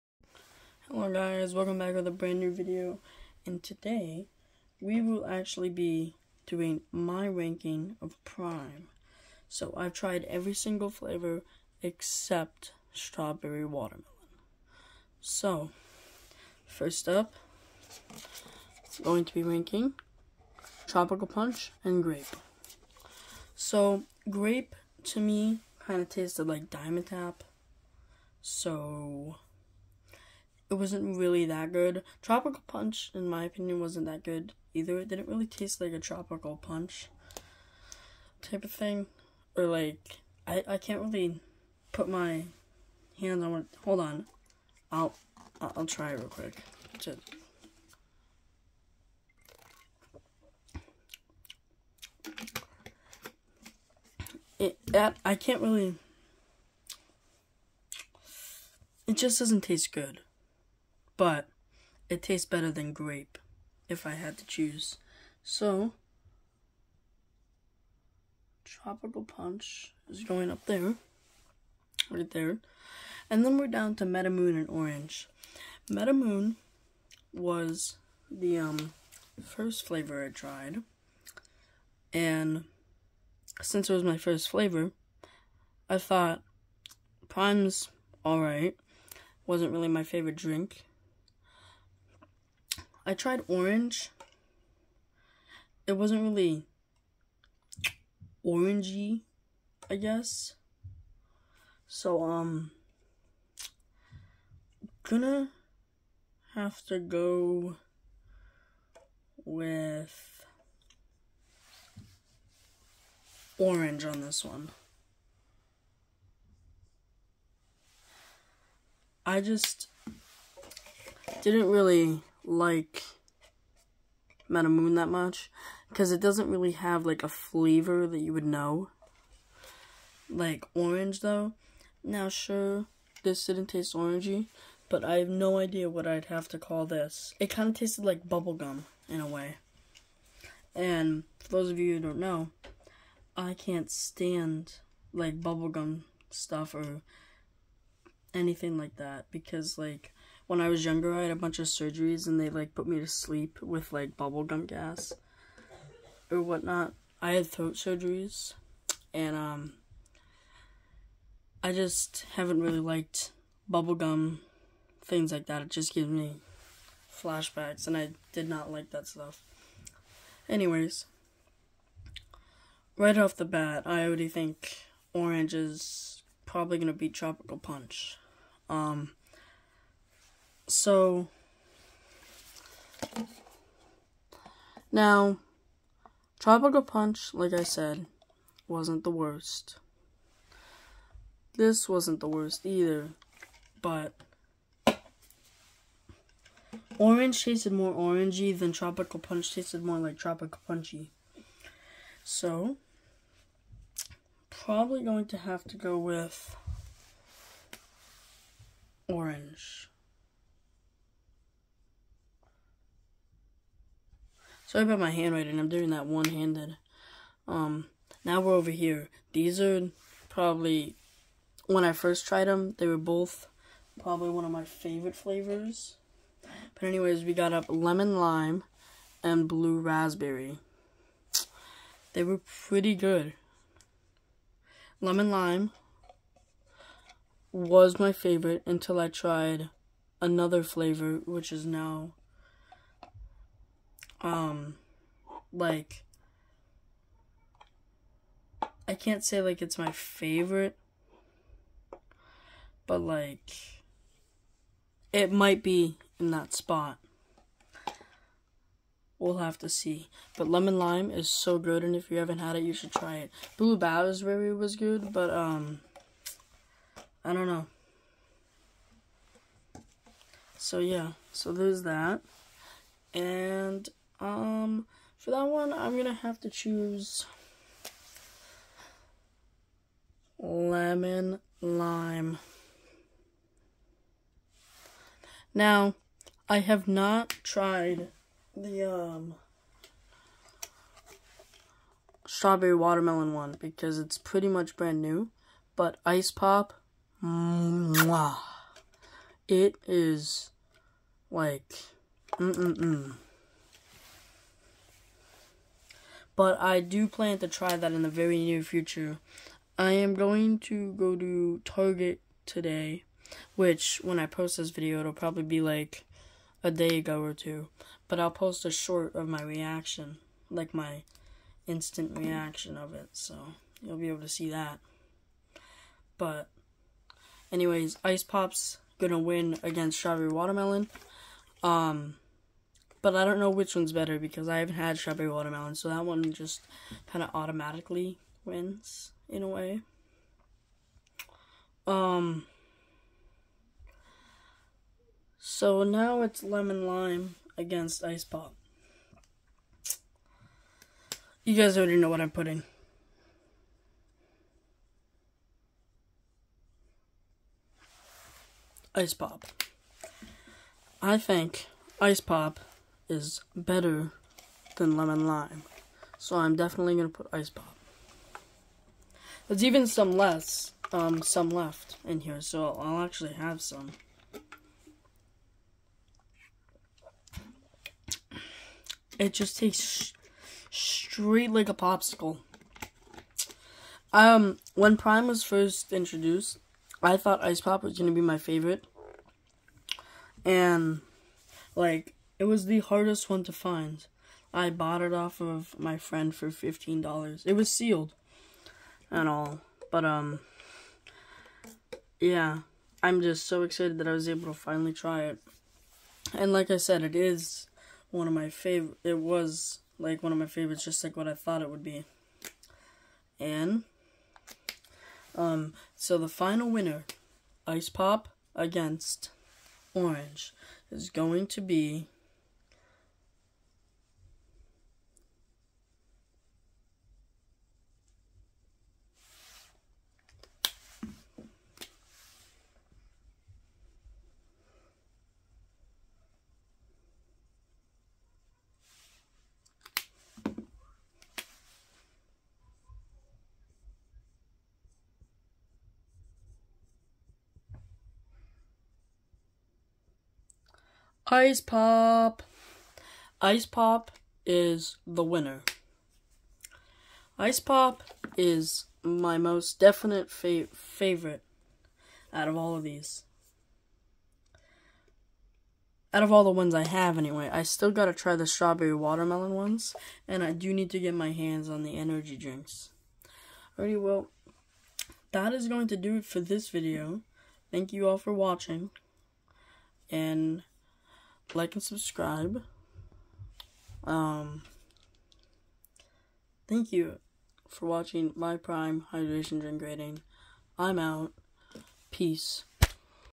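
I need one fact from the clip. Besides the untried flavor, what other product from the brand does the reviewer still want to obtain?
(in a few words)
Energy drinks.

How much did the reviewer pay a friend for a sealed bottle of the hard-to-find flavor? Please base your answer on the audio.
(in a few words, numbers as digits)
$15.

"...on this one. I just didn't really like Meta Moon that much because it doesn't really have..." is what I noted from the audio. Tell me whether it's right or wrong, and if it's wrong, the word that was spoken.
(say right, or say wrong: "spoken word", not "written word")
right.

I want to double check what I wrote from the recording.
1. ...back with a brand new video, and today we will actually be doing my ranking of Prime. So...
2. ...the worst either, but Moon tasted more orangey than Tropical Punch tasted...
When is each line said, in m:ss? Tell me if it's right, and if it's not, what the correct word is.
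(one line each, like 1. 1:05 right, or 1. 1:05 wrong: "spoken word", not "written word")
1. 0:01 right
2. 3:12 wrong: "Orange", not "Moon".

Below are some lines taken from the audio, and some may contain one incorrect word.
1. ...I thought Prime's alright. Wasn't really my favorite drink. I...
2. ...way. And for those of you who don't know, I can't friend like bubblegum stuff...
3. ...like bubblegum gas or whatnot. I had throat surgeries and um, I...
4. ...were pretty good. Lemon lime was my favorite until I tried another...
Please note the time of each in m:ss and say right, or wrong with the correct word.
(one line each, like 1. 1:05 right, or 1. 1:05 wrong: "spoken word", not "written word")
1. 1:25 right
2. 2:19 wrong: "stand", not "friend"
3. 2:33 right
4. 3:52 right.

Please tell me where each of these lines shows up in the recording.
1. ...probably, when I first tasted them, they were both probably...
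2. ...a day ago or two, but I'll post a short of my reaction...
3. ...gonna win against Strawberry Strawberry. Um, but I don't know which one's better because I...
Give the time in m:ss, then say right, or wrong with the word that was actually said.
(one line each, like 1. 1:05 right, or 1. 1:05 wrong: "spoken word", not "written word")
1. 3:40 wrong: "tried", not "tasted"
2. 5:16 right
3. 5:28 wrong: "Watermelon", not "Strawberry".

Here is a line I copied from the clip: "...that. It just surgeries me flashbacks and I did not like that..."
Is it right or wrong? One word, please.
wrong.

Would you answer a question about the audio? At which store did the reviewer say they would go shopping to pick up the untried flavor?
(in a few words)
Target.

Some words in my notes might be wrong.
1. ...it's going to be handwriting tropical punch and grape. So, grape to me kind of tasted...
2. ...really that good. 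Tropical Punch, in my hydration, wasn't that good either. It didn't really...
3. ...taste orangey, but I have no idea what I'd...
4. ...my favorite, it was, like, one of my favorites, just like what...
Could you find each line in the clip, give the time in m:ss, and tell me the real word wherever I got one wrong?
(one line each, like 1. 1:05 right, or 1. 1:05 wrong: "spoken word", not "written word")
1. 0:18 wrong: "ranking", not "handwriting"
2. 0:31 wrong: "opinion", not "hydration"
3. 2:13 right
4. 6:48 right.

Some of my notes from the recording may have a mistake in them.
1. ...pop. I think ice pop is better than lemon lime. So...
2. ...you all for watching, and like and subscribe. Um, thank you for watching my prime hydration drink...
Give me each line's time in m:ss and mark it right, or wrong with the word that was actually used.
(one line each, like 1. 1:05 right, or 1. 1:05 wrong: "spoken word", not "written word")
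1. 5:59 right
2. 7:57 right.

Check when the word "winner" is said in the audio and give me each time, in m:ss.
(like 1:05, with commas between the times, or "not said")
6:56, 7:35.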